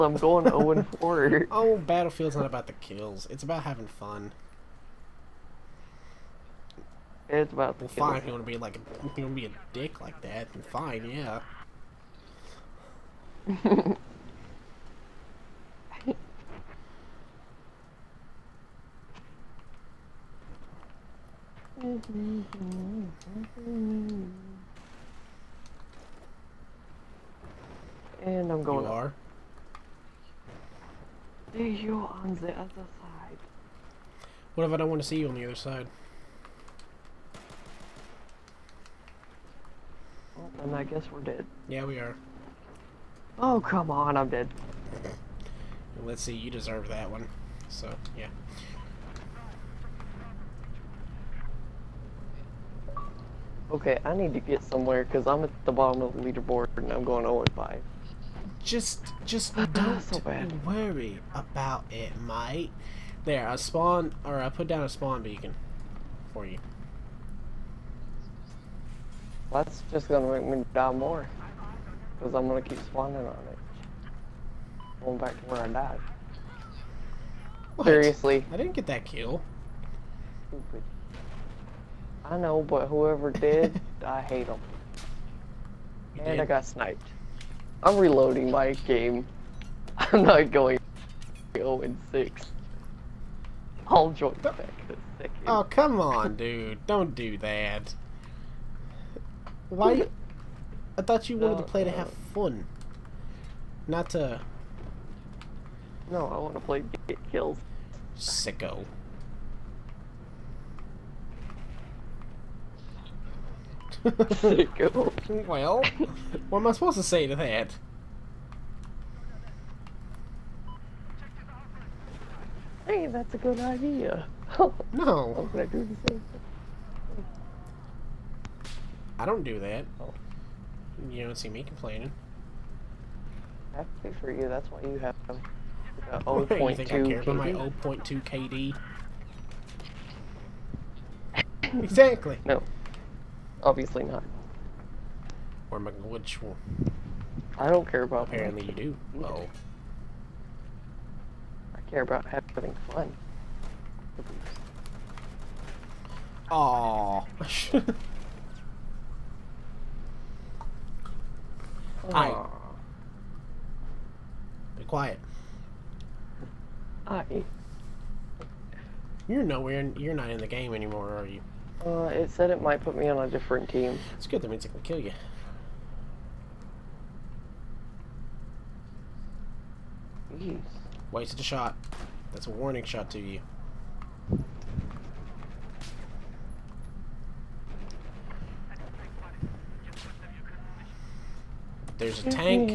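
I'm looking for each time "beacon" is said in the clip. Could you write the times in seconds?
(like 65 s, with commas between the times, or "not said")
65 s.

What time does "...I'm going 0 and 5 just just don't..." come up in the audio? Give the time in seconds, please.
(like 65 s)
56 s.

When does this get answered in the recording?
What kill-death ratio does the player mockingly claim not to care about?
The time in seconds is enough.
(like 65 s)
137 s.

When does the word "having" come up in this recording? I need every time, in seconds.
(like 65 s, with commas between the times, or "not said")
3 s, 152 s.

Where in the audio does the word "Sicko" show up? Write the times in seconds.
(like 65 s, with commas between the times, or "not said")
108 s.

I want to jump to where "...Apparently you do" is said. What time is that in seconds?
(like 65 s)
148 s.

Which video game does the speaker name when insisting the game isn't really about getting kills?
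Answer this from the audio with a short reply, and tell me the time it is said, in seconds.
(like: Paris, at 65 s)
Battlefield, at 1 s.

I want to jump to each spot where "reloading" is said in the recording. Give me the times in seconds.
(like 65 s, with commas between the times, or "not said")
87 s.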